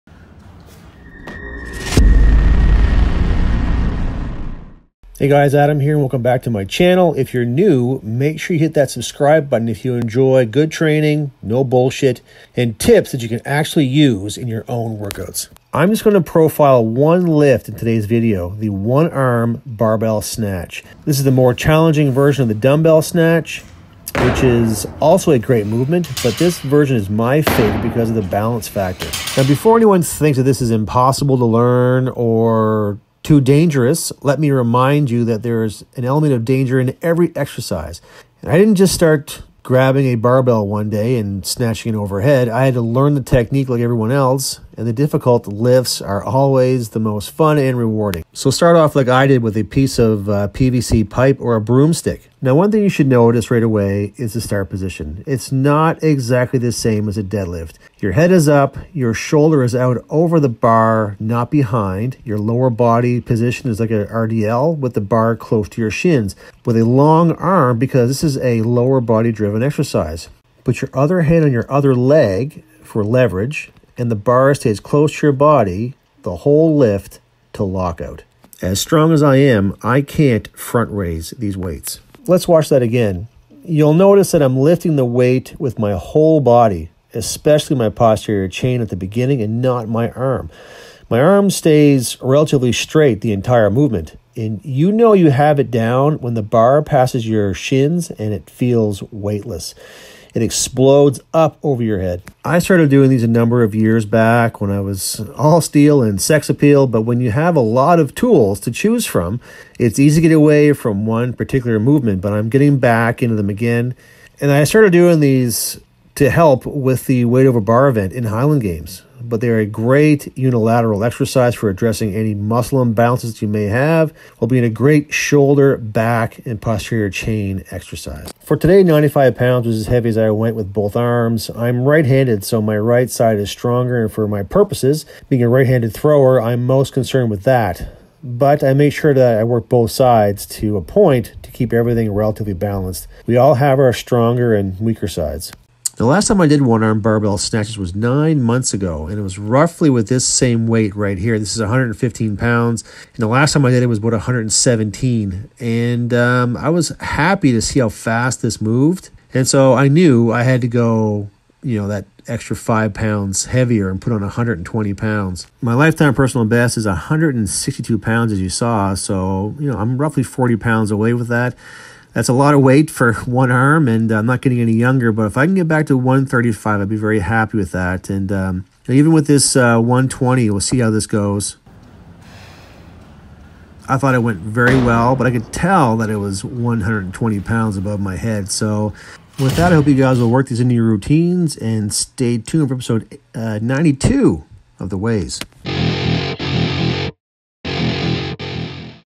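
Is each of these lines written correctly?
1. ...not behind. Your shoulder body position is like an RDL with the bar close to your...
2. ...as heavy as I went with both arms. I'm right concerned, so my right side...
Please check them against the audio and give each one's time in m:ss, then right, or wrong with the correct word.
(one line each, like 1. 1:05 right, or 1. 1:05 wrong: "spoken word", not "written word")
1. 1:01 wrong: "lower", not "shoulder"
2. 2:09 wrong: "handed", not "concerned".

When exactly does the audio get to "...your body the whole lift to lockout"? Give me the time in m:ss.
1:15.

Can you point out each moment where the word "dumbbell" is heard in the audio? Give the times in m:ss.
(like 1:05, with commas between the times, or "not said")
0:22.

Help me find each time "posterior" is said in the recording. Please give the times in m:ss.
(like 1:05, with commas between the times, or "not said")
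1:27, 2:06.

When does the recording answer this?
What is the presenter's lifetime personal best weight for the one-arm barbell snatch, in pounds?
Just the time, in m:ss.
2:46.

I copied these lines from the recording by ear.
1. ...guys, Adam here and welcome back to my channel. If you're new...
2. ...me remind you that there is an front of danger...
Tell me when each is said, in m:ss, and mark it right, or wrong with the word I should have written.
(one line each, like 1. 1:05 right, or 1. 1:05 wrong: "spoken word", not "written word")
1. 0:05 right
2. 0:34 wrong: "element", not "front".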